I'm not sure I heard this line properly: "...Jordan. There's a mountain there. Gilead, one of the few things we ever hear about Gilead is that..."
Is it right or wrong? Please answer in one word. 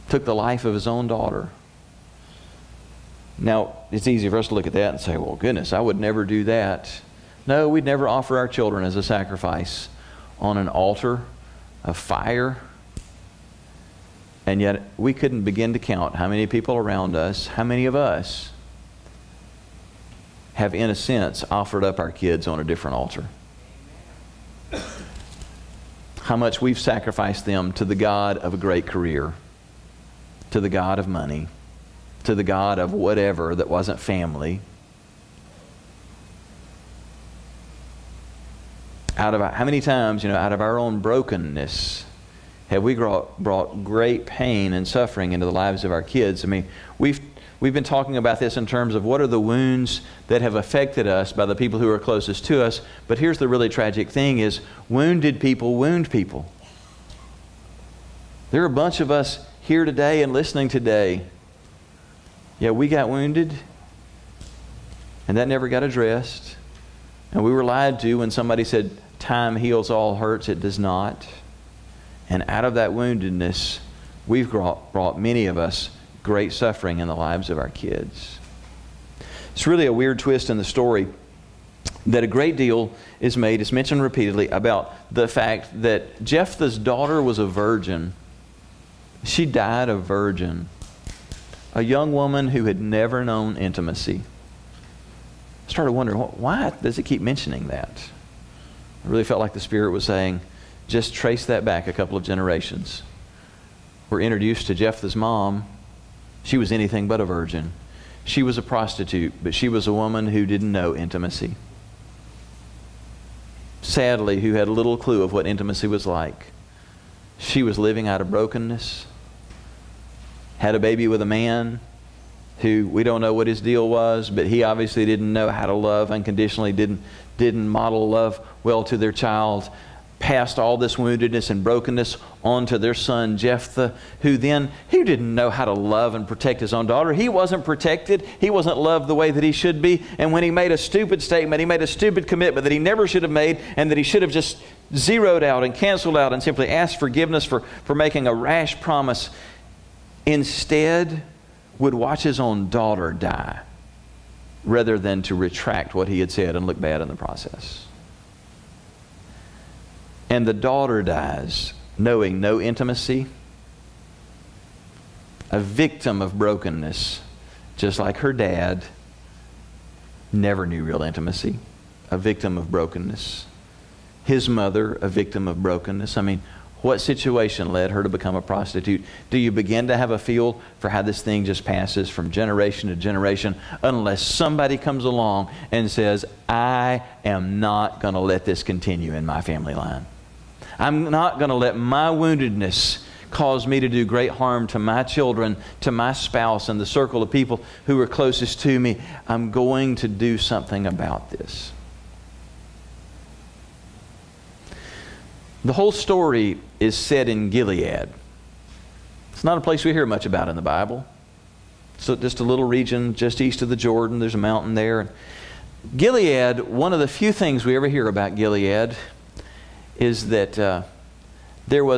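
right.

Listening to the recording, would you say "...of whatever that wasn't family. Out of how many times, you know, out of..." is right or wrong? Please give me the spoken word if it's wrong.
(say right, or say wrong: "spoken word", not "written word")
right.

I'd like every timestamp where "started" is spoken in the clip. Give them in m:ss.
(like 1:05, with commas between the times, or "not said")
1:35.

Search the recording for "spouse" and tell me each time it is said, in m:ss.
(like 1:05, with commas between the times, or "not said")
3:16.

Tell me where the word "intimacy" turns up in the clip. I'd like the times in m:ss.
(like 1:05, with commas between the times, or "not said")
1:33, 1:50, 1:55, 2:42, 2:51.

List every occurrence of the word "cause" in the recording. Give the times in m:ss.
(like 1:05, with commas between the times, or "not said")
3:13.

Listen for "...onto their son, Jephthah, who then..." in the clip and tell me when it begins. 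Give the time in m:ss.
2:12.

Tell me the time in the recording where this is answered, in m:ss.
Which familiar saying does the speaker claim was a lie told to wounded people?
1:09.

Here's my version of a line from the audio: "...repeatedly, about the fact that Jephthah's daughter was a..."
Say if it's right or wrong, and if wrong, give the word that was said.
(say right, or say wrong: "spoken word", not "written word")
right.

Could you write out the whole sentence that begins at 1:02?
Yeah, we got wounded, and that never got addressed.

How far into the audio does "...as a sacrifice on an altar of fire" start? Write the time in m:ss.
0:08.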